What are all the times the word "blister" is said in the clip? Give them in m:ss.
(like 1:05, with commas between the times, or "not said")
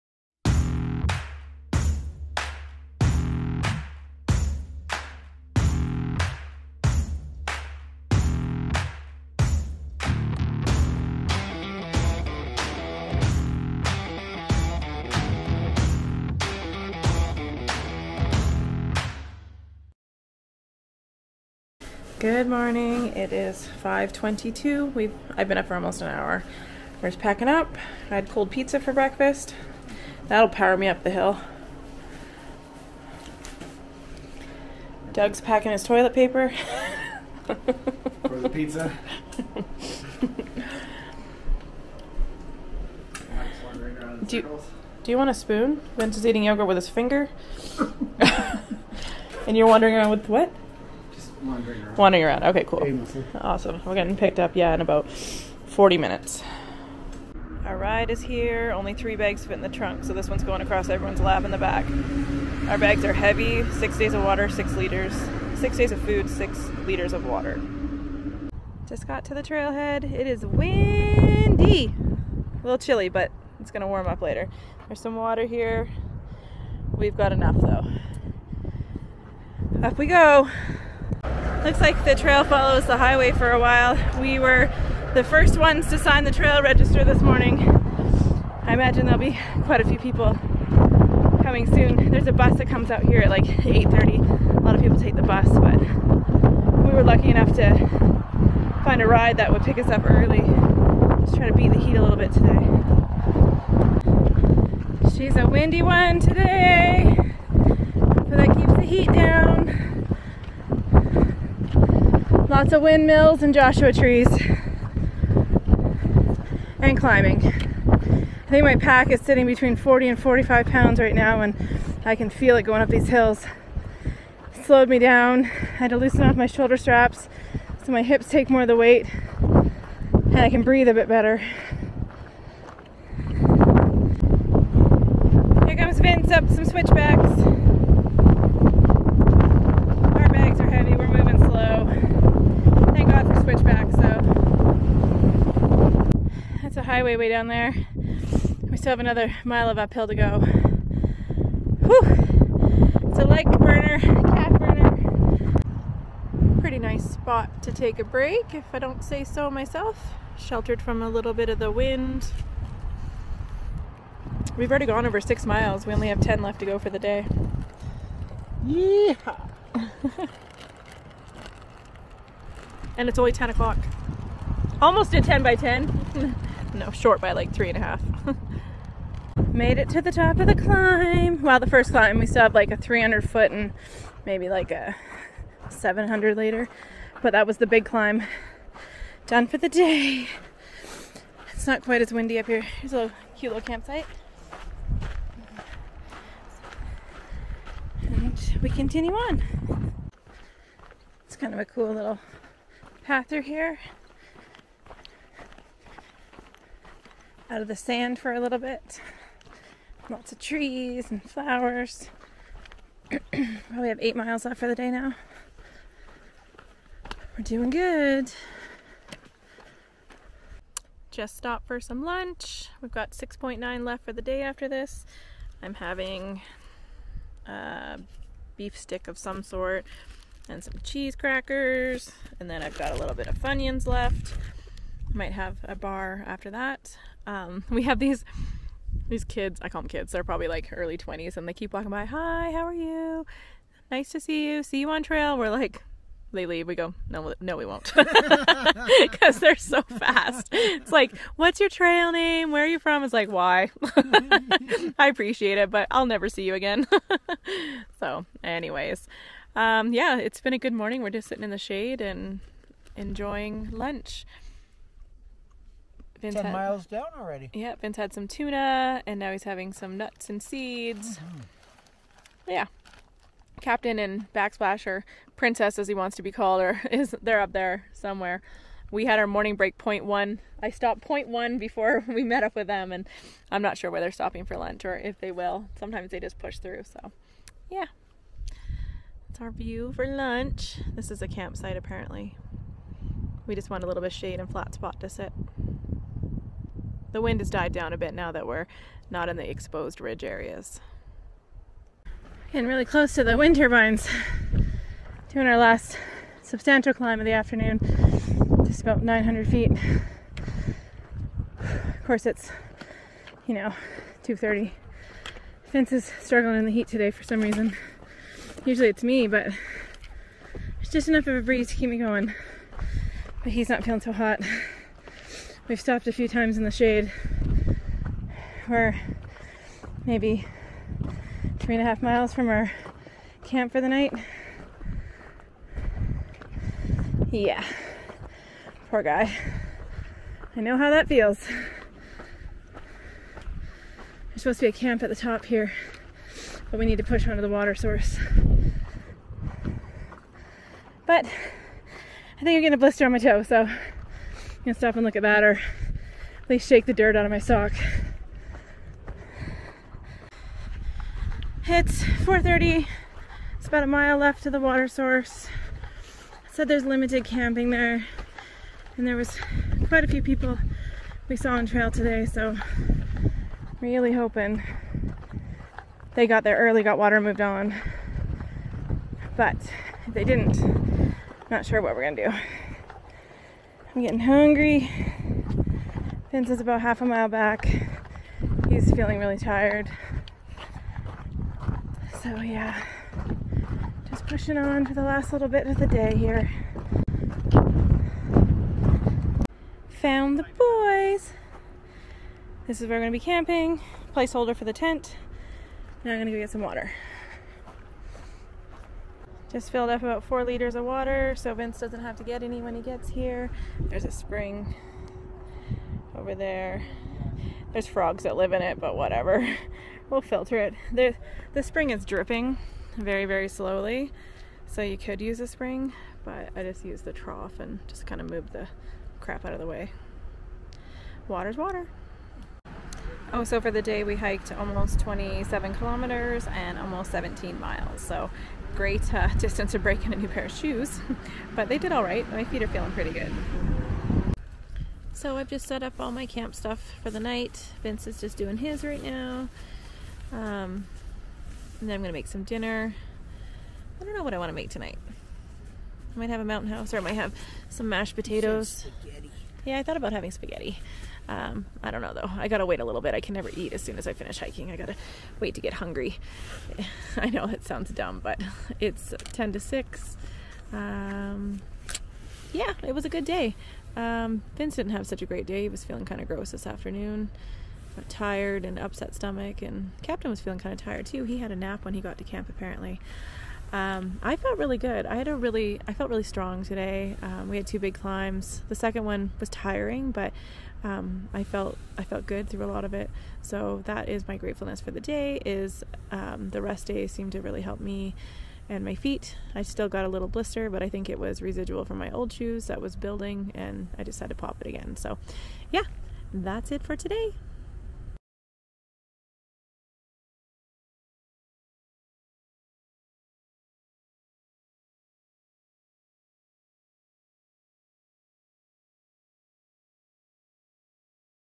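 5:52, 8:20.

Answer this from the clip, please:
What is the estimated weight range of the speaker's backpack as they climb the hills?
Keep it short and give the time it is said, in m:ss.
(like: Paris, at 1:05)
40 to 45 pounds, at 1:59.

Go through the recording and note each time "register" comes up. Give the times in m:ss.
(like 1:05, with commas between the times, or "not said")
1:26.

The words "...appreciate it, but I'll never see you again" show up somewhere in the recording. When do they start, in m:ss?
4:15.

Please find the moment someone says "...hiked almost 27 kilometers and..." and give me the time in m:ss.
7:14.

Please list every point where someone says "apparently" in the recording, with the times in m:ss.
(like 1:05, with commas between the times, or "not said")
4:51, 8:02.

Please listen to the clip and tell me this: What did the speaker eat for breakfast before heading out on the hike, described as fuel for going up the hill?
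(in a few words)
Cold pizza.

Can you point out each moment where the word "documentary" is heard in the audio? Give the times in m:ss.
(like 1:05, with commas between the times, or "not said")
not said.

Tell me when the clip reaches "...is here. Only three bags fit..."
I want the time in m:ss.
0:58.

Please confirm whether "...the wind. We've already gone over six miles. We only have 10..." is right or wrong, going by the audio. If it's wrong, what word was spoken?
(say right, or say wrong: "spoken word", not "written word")
right.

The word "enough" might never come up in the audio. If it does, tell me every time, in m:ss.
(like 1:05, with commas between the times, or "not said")
1:17, 1:37, 5:21.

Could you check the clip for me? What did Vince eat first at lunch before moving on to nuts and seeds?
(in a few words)
Tuna.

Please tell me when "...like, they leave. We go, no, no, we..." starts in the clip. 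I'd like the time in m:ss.
4:05.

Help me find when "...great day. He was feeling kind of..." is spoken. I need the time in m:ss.
7:55.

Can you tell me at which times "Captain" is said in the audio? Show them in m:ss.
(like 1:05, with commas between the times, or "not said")
4:33, 8:00.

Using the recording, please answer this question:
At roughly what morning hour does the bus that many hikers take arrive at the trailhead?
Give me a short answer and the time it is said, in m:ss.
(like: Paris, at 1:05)
8:30, at 1:33.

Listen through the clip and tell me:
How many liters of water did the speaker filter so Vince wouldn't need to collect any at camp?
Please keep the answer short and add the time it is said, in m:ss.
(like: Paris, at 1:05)
4, at 6:50.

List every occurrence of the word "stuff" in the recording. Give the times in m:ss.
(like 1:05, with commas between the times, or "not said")
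7:26.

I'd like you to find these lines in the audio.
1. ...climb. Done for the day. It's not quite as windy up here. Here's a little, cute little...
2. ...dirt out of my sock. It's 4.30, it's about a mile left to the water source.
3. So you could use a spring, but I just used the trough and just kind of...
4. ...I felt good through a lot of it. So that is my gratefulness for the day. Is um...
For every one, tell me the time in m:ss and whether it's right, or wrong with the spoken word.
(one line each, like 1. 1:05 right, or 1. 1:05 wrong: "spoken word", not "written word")
1. 3:07 right
2. 5:56 right
3. 7:04 right
4. 8:11 right.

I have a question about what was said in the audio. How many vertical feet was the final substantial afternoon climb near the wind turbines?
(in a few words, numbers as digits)
900 feet.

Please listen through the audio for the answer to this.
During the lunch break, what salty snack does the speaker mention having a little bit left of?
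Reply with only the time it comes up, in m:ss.
3:53.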